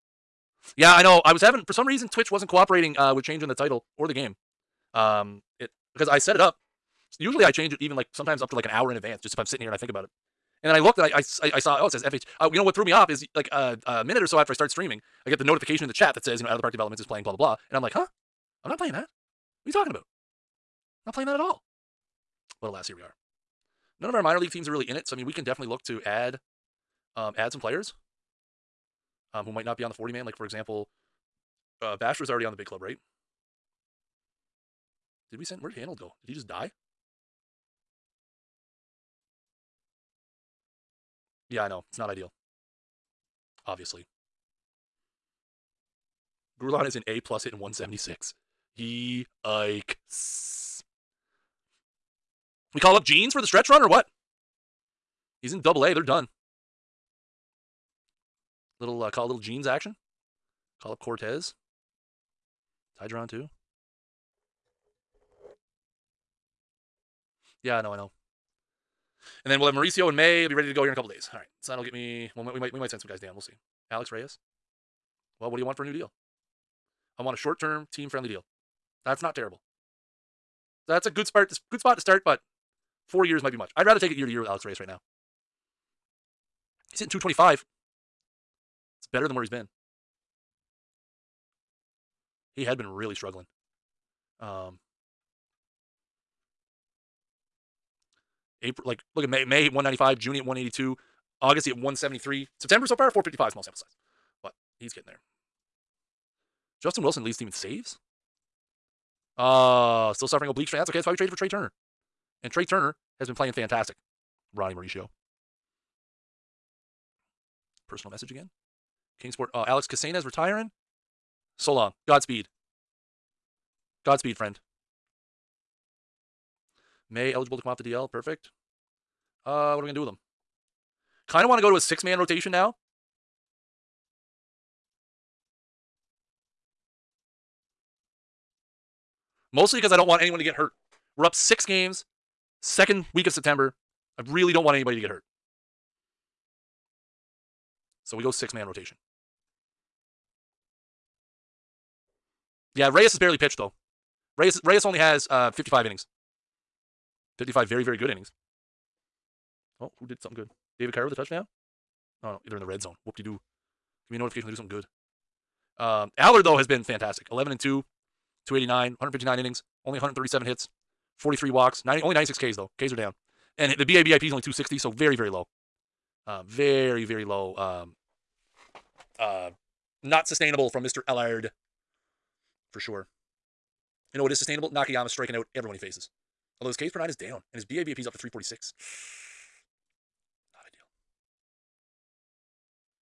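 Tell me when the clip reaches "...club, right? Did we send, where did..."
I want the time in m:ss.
0:32.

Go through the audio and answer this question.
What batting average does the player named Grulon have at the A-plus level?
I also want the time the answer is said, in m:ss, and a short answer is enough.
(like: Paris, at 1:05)
176, at 0:47.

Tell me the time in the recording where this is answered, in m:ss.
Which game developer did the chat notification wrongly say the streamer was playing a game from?
0:16.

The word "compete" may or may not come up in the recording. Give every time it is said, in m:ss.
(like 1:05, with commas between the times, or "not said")
not said.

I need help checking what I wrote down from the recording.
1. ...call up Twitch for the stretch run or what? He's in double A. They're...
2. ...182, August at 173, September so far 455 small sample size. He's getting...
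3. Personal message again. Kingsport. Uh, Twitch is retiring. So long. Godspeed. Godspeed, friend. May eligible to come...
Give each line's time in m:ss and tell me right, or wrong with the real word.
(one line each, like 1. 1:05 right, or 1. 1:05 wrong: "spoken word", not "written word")
1. 0:52 wrong: "Jeans", not "Twitch"
2. 1:40 right
3. 1:57 wrong: "Alex", not "Twitch".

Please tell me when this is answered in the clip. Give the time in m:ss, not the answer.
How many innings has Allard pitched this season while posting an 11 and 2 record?
2:48.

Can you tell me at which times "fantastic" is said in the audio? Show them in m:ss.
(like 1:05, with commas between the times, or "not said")
1:53, 2:46.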